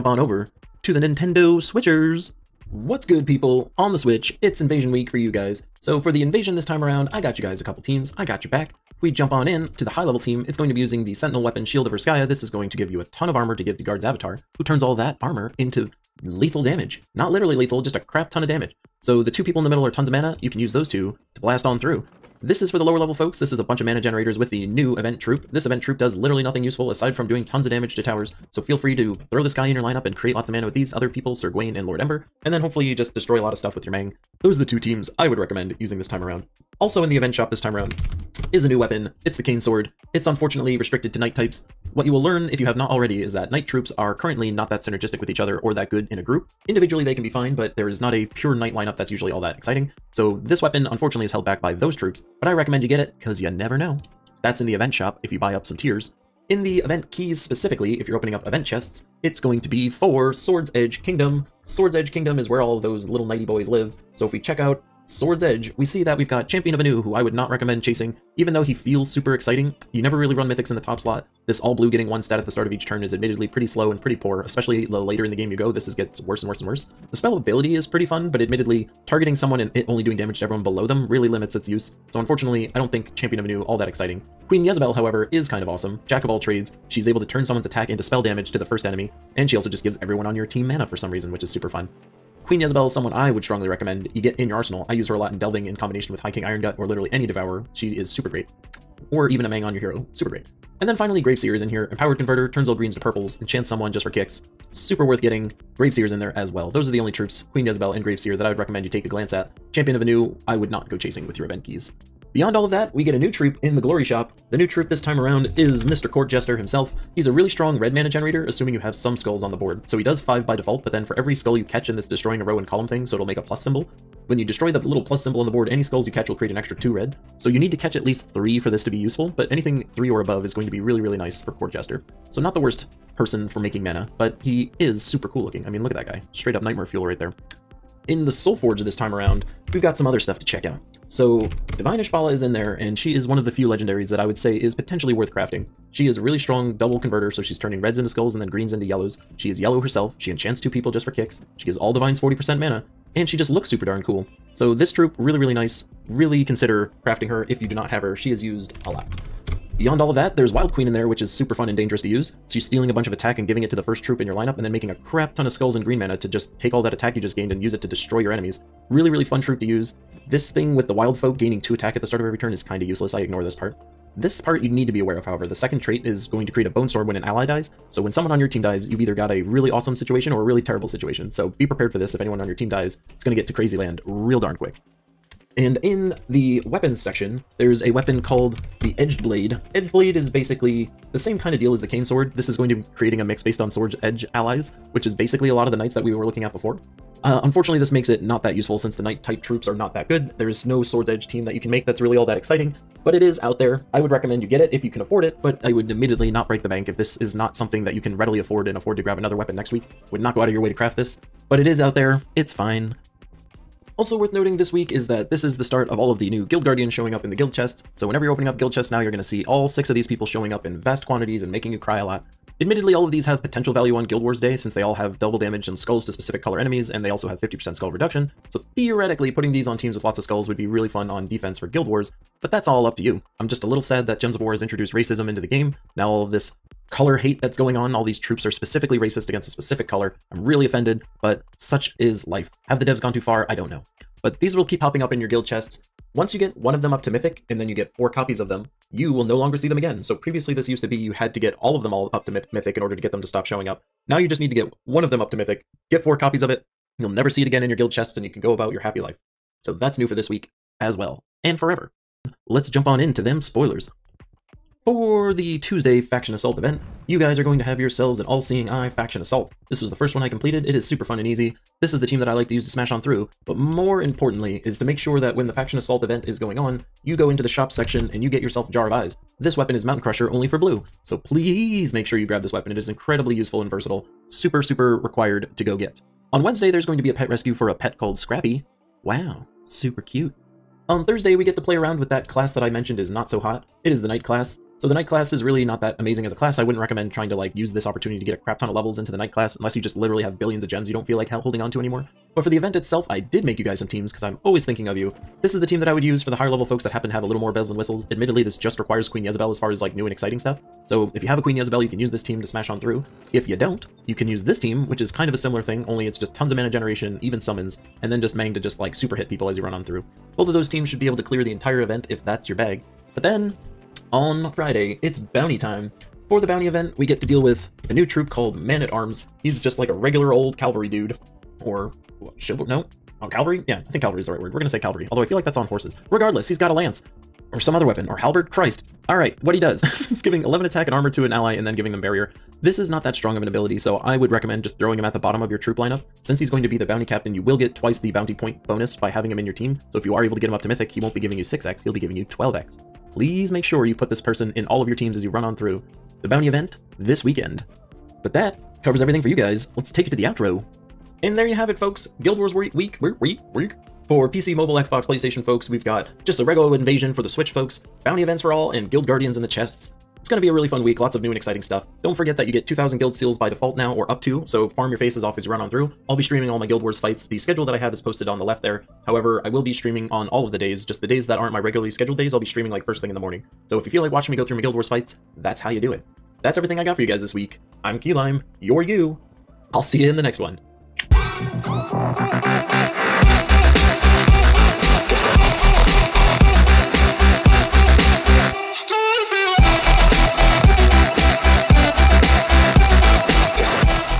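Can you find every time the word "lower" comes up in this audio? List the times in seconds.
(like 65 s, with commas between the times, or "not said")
22 s.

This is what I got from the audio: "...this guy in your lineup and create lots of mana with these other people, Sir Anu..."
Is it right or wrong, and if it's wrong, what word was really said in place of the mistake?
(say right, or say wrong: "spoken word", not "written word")
wrong: "Gwayne", not "Anu".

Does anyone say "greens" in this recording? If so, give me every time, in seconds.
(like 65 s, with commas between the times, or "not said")
102 s, 148 s, 165 s.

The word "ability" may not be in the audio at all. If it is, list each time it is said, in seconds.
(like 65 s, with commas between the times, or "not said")
77 s, 343 s.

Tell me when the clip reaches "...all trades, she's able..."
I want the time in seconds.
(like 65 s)
86 s.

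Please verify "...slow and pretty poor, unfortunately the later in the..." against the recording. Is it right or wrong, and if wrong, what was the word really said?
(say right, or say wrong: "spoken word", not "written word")
wrong: "especially", not "unfortunately".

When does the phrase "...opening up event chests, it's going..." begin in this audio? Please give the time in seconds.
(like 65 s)
58 s.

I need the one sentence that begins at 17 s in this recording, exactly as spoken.
Not literally lethal, just a crap ton of damage.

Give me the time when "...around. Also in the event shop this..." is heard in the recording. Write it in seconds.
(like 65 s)
36 s.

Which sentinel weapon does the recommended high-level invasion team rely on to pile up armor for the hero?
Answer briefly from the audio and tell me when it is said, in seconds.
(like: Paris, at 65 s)
Shield of Urskaya, at 11 s.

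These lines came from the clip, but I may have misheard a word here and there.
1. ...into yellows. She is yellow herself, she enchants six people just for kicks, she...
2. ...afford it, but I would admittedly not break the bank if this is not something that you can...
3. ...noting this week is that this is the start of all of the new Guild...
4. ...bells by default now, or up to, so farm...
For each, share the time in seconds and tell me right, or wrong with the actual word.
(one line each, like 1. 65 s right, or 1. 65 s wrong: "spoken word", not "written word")
1. 148 s wrong: "two", not "six"
2. 204 s right
3. 214 s right
4. 373 s wrong: "seals", not "bells".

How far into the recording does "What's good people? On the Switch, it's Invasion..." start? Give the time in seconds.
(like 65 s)
2 s.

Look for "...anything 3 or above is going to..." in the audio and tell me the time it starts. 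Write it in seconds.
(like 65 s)
129 s.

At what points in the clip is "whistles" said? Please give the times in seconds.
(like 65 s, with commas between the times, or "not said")
307 s.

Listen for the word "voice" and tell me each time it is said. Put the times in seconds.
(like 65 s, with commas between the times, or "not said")
not said.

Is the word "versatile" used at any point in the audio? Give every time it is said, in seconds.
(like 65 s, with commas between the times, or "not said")
283 s.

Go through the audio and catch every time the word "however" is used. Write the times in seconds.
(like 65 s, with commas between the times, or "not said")
84 s, 175 s, 379 s.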